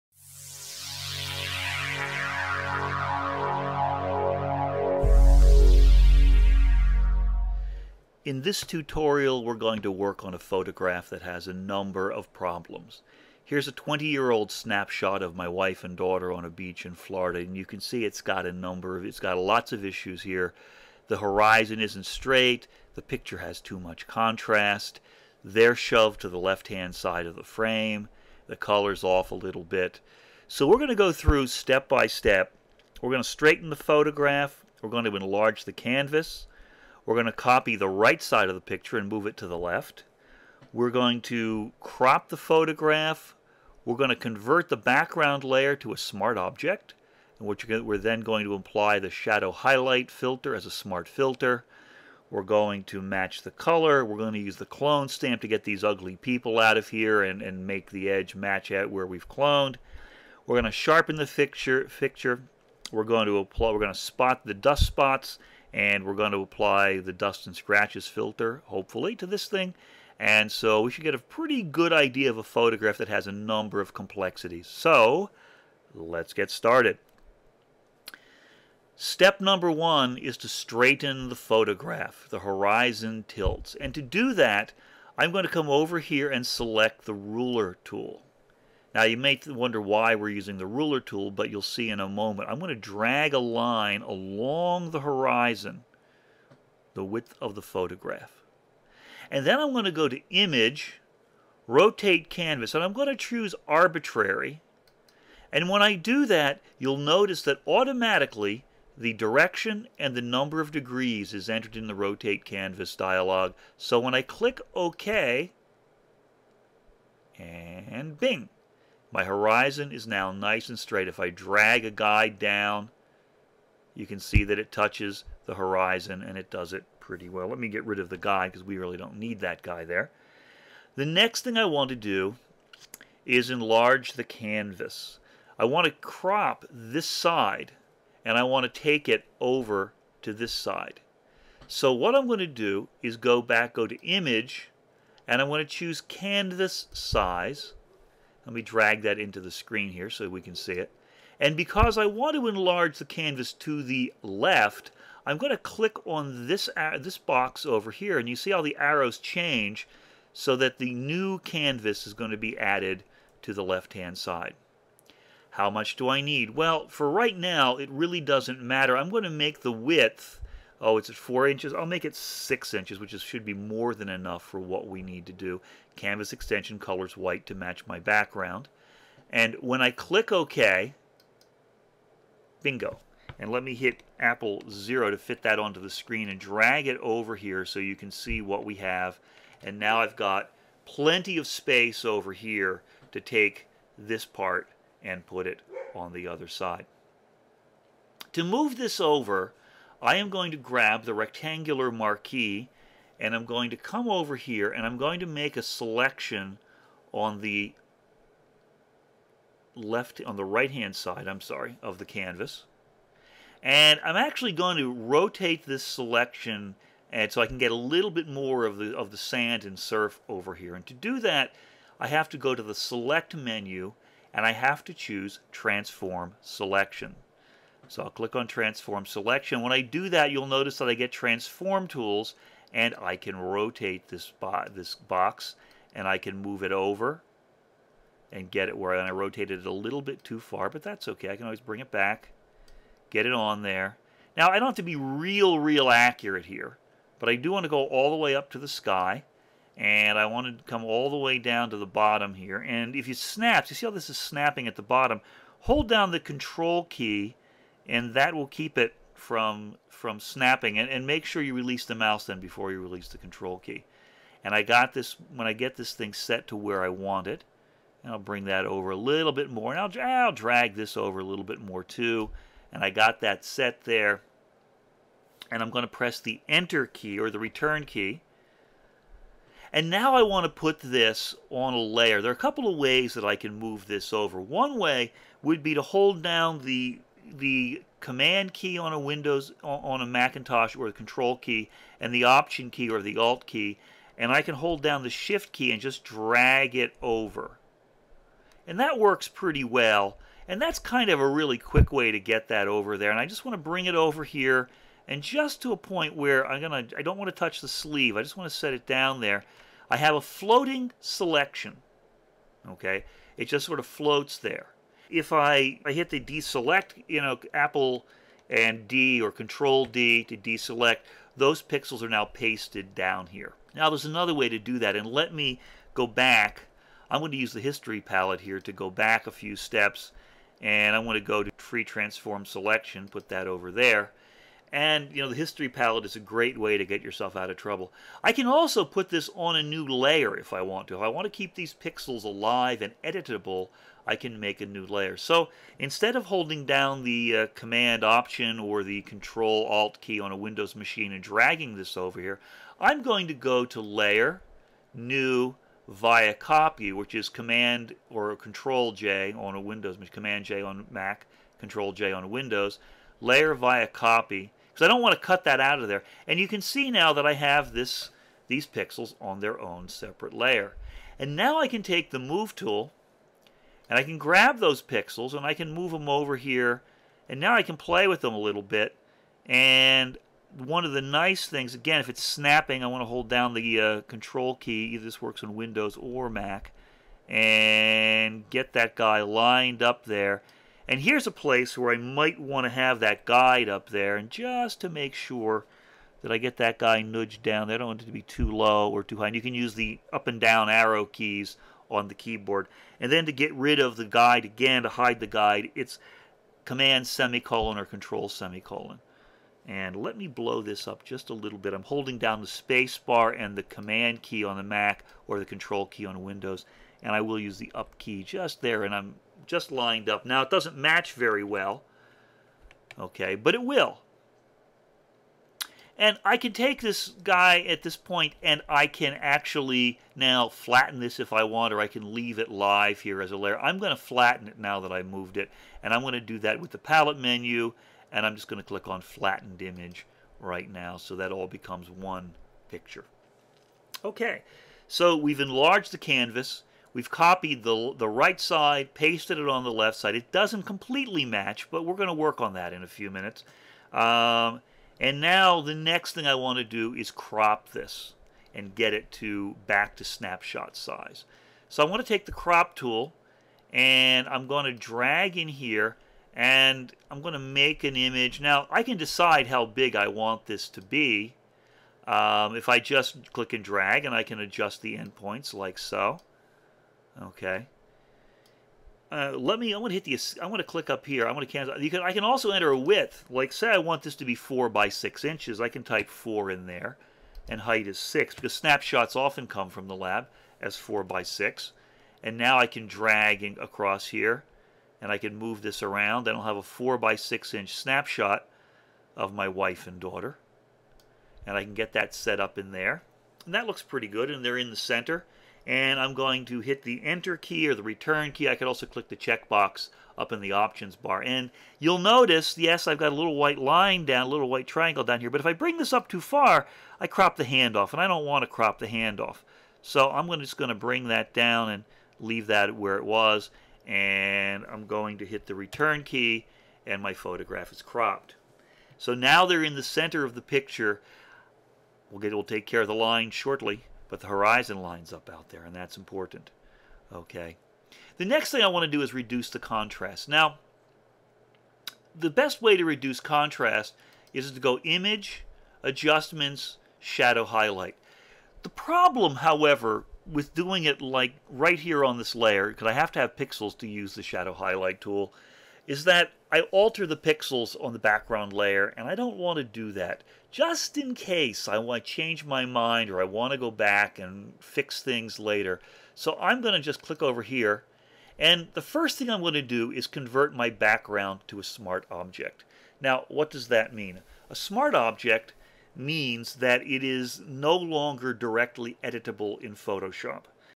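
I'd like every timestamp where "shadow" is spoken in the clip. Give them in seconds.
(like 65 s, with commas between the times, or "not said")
49 s, 546 s, 554 s.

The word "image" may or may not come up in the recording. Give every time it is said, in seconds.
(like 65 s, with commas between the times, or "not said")
100 s, 144 s, 439 s, 467 s, 544 s.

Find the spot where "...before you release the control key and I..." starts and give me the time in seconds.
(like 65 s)
262 s.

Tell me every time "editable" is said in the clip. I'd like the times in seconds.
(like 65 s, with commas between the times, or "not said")
343 s, 579 s.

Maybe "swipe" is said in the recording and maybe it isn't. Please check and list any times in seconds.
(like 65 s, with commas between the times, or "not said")
not said.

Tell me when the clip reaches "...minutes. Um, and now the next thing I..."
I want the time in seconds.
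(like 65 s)
453 s.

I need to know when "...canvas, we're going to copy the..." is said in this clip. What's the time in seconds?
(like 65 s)
35 s.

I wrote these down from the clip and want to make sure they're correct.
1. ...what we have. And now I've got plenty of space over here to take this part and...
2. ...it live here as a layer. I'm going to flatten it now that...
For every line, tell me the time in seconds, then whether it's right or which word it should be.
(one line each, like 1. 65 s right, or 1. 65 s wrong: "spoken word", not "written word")
1. 188 s right
2. 432 s right.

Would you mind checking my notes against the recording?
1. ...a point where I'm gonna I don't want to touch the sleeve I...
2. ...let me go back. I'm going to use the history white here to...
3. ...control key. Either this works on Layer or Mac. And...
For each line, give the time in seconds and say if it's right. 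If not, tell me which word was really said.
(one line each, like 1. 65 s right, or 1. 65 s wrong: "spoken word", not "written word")
1. 305 s right
2. 325 s wrong: "palette", not "white"
3. 384 s wrong: "Windows", not "Layer".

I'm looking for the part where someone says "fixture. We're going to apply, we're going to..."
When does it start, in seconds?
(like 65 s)
61 s.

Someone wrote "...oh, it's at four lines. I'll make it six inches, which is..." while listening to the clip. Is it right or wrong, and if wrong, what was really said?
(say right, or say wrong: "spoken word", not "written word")
wrong: "inches", not "lines".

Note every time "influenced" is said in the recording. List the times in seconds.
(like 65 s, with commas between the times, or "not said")
not said.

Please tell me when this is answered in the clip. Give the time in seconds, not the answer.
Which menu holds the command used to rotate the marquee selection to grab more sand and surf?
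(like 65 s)
222 s.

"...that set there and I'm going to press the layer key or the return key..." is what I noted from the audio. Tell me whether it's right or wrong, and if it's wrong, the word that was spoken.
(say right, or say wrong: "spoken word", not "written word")
wrong: "enter", not "layer".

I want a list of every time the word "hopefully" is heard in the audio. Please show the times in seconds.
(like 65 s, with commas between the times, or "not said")
68 s.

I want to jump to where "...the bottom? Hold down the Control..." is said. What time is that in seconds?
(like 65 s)
254 s.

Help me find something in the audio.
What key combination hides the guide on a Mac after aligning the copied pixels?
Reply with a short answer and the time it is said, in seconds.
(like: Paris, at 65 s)
Command semicolon, at 406 s.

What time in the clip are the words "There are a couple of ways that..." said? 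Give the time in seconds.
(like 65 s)
282 s.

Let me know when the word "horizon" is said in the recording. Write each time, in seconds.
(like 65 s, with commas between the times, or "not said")
21 s, 82 s, 94 s, 119 s, 125 s, 534 s.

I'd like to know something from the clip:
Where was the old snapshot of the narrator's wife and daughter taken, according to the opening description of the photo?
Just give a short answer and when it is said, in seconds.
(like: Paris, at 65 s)
Florida, at 16 s.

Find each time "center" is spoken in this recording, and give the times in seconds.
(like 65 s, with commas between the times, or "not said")
504 s, 529 s.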